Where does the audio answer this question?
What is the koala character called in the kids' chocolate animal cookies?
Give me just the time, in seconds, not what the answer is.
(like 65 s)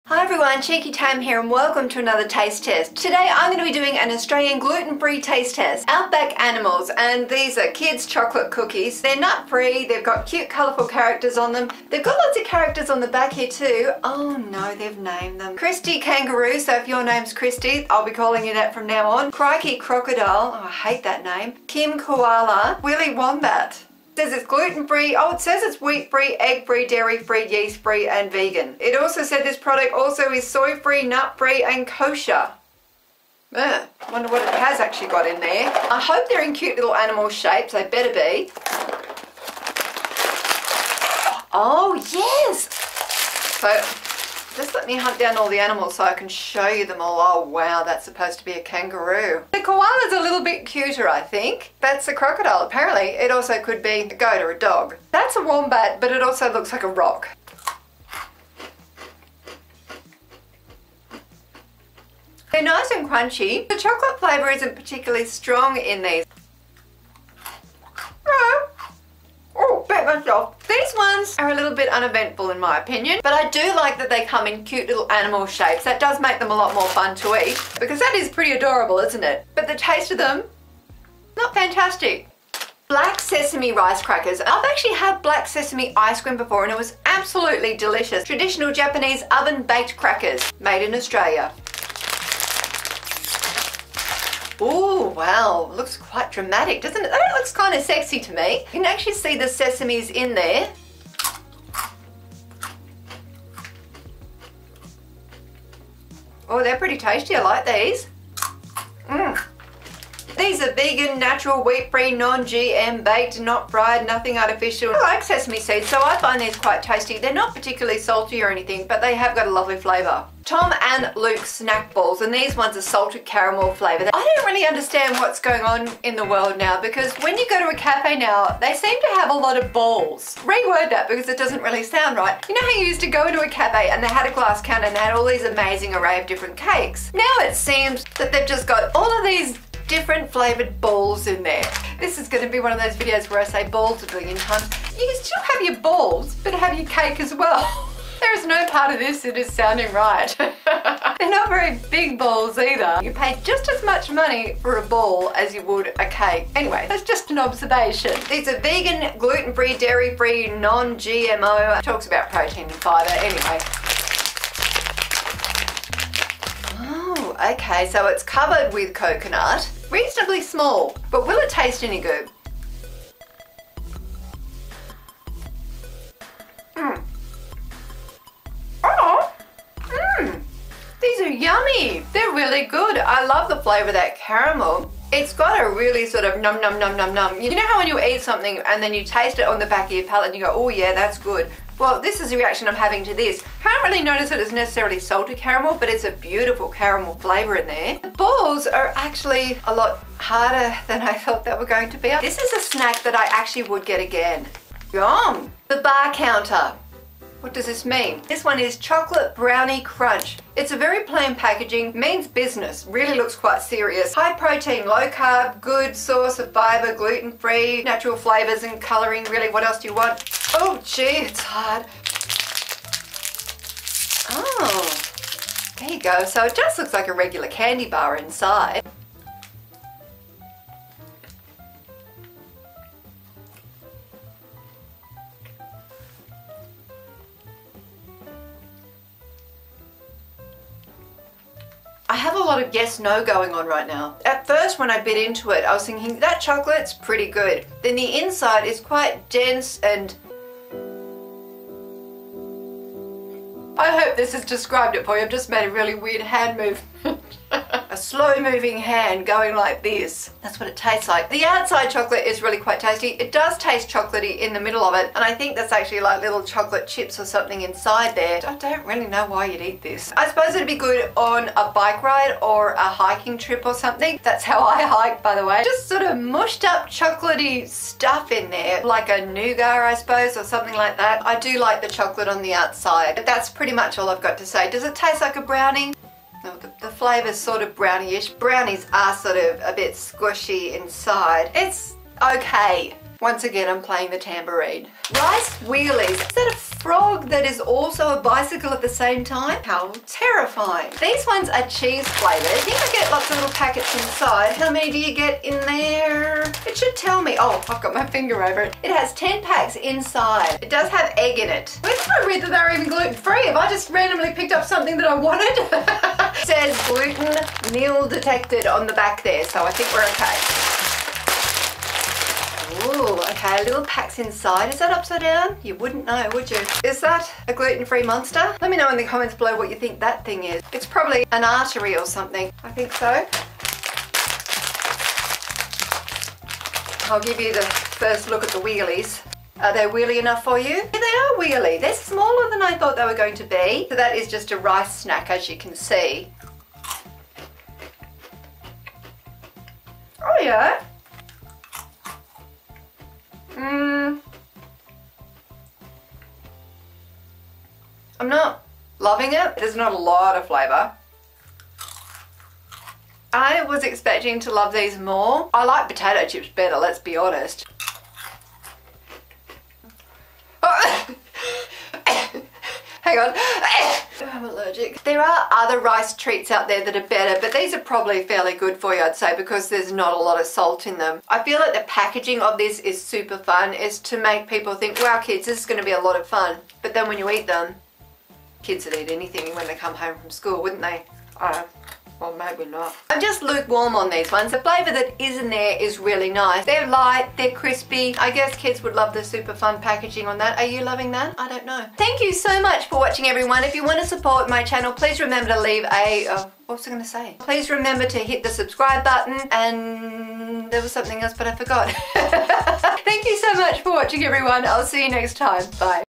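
21 s.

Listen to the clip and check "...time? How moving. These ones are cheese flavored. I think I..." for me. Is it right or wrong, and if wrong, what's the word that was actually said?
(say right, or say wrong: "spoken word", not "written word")
wrong: "terrifying", not "moving".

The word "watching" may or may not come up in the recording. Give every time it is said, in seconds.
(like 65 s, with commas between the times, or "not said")
402 s, 413 s.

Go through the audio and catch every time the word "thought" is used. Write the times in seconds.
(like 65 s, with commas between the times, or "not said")
201 s, 342 s.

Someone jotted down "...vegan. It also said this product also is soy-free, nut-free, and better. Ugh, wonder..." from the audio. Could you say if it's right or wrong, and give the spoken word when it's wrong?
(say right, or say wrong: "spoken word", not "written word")
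wrong: "kosher", not "better".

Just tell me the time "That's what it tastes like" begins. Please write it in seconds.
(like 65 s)
260 s.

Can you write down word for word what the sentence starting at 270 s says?
I suppose it'd be good on a bike ride or a hiking trip or something.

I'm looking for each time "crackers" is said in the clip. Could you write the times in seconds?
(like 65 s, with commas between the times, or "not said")
84 s, 89 s.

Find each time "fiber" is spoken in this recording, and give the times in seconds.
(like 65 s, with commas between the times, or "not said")
162 s, 216 s.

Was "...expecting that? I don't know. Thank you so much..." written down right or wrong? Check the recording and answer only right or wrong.
wrong.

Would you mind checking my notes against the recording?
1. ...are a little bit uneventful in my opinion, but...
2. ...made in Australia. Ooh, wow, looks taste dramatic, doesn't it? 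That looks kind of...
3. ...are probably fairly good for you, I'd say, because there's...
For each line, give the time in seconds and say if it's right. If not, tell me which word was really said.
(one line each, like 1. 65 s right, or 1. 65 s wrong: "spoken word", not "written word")
1. 71 s right
2. 90 s wrong: "quite", not "taste"
3. 377 s right.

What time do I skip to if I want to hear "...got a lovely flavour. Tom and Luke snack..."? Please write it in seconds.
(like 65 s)
119 s.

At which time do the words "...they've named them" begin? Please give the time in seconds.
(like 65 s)
14 s.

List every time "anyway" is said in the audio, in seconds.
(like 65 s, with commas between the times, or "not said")
156 s, 163 s.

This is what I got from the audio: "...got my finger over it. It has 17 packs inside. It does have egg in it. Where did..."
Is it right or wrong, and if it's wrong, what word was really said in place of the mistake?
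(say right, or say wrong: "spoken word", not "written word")
wrong: "10", not "17".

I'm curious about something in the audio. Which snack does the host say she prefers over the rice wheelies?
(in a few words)
Potato chips.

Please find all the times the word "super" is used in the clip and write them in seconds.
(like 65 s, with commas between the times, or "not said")
383 s, 399 s.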